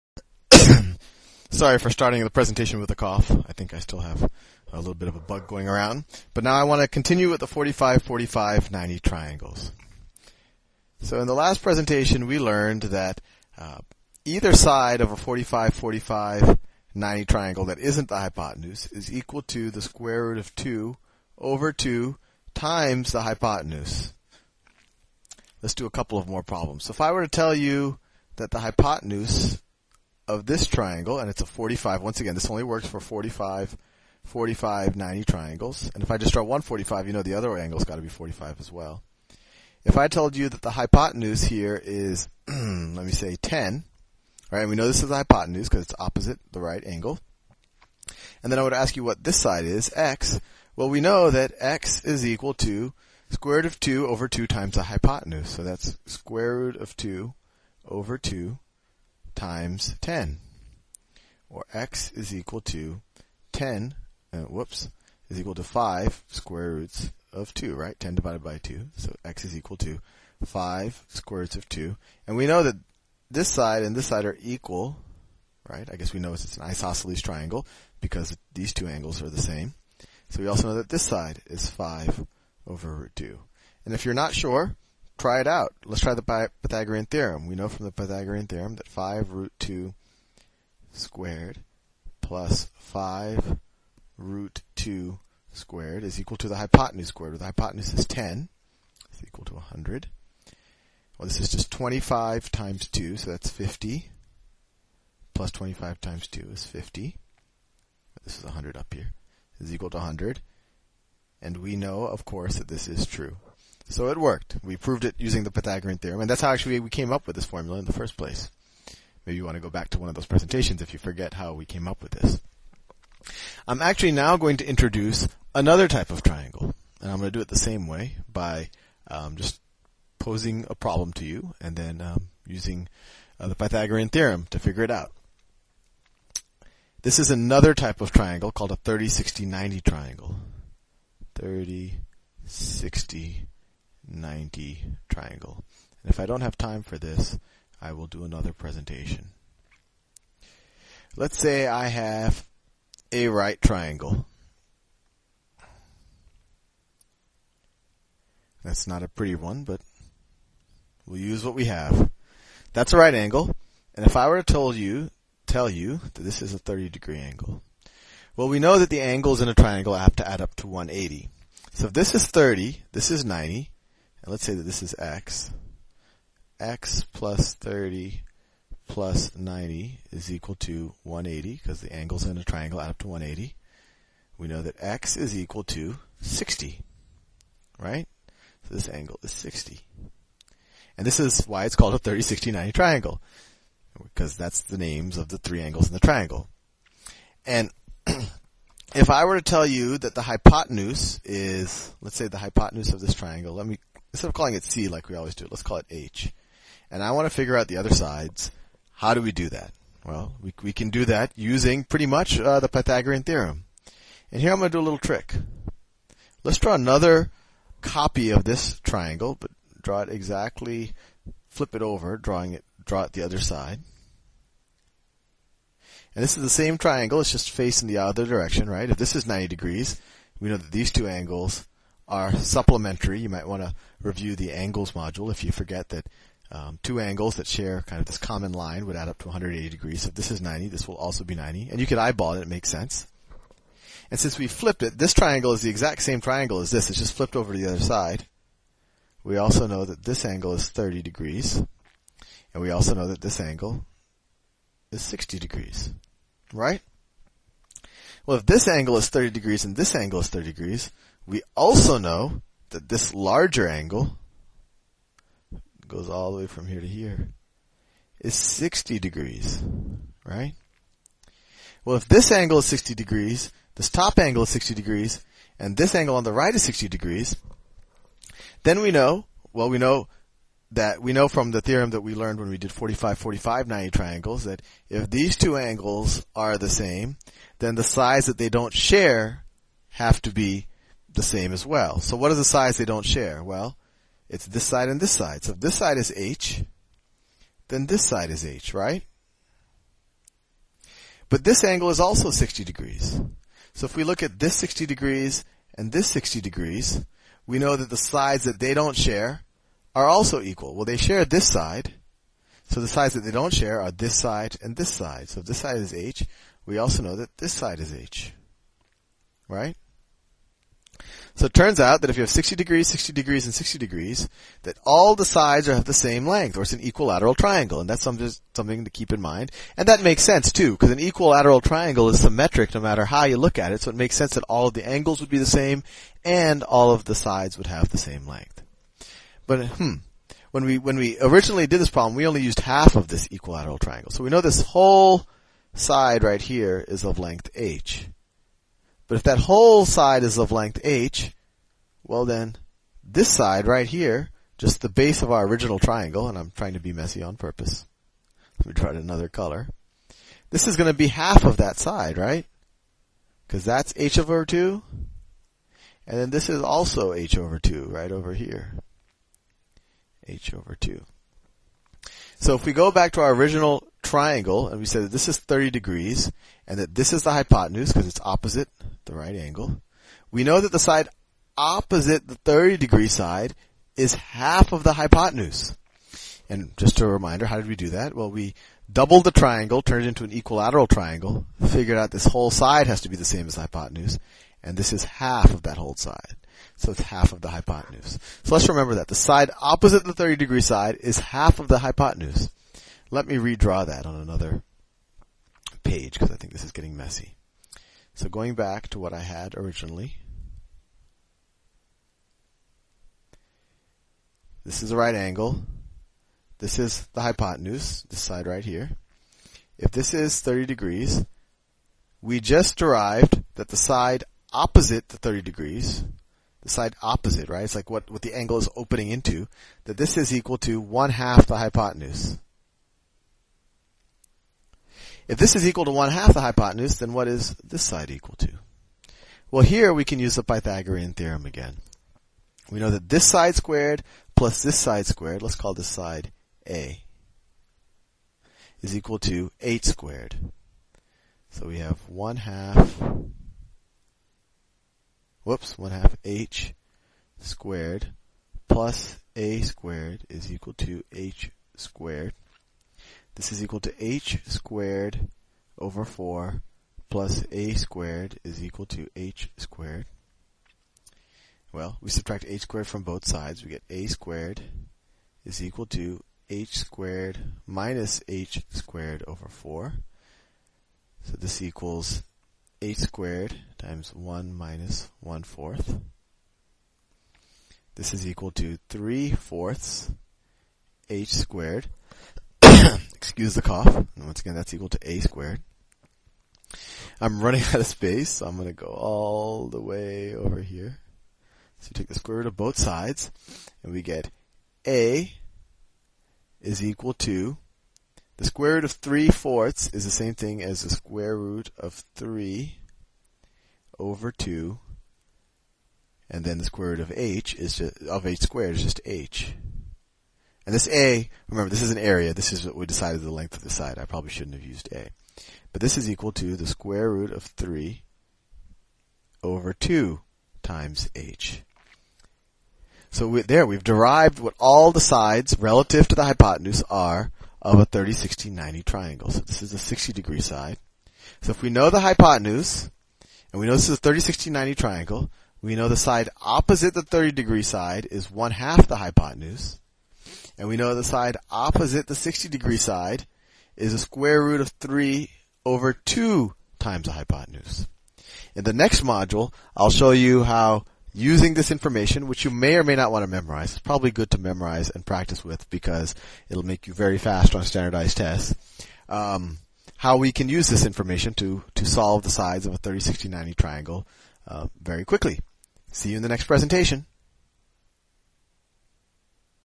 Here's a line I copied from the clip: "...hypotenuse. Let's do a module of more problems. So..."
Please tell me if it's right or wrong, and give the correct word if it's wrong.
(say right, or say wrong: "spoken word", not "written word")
wrong: "couple", not "module".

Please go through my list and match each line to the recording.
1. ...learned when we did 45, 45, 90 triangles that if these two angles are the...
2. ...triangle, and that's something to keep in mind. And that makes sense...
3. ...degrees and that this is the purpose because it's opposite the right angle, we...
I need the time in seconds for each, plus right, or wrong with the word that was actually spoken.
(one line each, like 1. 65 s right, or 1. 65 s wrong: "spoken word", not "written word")
1. 282 s right
2. 327 s right
3. 375 s wrong: "hypotenuse", not "purpose".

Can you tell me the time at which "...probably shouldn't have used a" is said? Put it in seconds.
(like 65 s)
524 s.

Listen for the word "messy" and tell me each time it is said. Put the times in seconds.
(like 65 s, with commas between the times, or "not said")
356 s, 406 s.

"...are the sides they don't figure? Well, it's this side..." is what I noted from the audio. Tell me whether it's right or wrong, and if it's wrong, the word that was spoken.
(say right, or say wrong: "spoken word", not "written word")
wrong: "share", not "figure".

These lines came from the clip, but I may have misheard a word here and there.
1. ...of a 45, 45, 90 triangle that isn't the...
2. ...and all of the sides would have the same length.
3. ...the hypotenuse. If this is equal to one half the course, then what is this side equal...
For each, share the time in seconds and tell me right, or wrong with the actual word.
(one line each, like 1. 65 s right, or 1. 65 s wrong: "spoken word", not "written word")
1. 15 s right
2. 336 s right
3. 431 s wrong: "hypotenuse", not "course".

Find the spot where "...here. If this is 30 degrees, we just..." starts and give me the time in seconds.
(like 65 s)
418 s.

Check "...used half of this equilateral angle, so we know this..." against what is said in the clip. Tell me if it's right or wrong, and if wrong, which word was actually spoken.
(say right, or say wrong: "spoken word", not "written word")
wrong: "triangle", not "angle".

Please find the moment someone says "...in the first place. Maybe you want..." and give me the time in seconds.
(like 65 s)
117 s.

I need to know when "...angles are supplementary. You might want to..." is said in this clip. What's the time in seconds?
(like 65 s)
231 s.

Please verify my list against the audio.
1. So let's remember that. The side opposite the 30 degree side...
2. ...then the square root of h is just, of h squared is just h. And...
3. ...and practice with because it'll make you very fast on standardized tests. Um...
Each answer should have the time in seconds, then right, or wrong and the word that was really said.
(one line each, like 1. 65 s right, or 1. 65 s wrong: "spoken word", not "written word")
1. 398 s right
2. 516 s right
3. 564 s right.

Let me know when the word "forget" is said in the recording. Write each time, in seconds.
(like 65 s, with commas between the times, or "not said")
120 s, 235 s.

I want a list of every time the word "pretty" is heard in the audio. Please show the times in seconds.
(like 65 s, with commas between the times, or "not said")
159 s, 211 s.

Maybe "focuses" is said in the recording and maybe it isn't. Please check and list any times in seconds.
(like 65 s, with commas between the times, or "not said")
not said.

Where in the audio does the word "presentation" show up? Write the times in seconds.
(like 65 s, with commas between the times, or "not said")
2 s, 11 s, 120 s, 148 s, 576 s.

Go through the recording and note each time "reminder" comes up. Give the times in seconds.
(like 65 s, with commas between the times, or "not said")
387 s.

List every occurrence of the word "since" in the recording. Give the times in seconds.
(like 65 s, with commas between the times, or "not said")
244 s.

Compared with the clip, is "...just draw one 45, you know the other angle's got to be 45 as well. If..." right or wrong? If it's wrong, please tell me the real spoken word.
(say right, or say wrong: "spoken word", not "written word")
right.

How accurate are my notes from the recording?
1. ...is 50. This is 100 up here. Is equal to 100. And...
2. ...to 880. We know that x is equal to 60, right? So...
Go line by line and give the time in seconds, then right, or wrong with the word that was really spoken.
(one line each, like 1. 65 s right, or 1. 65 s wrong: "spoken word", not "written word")
1. 106 s right
2. 182 s wrong: "180", not "880".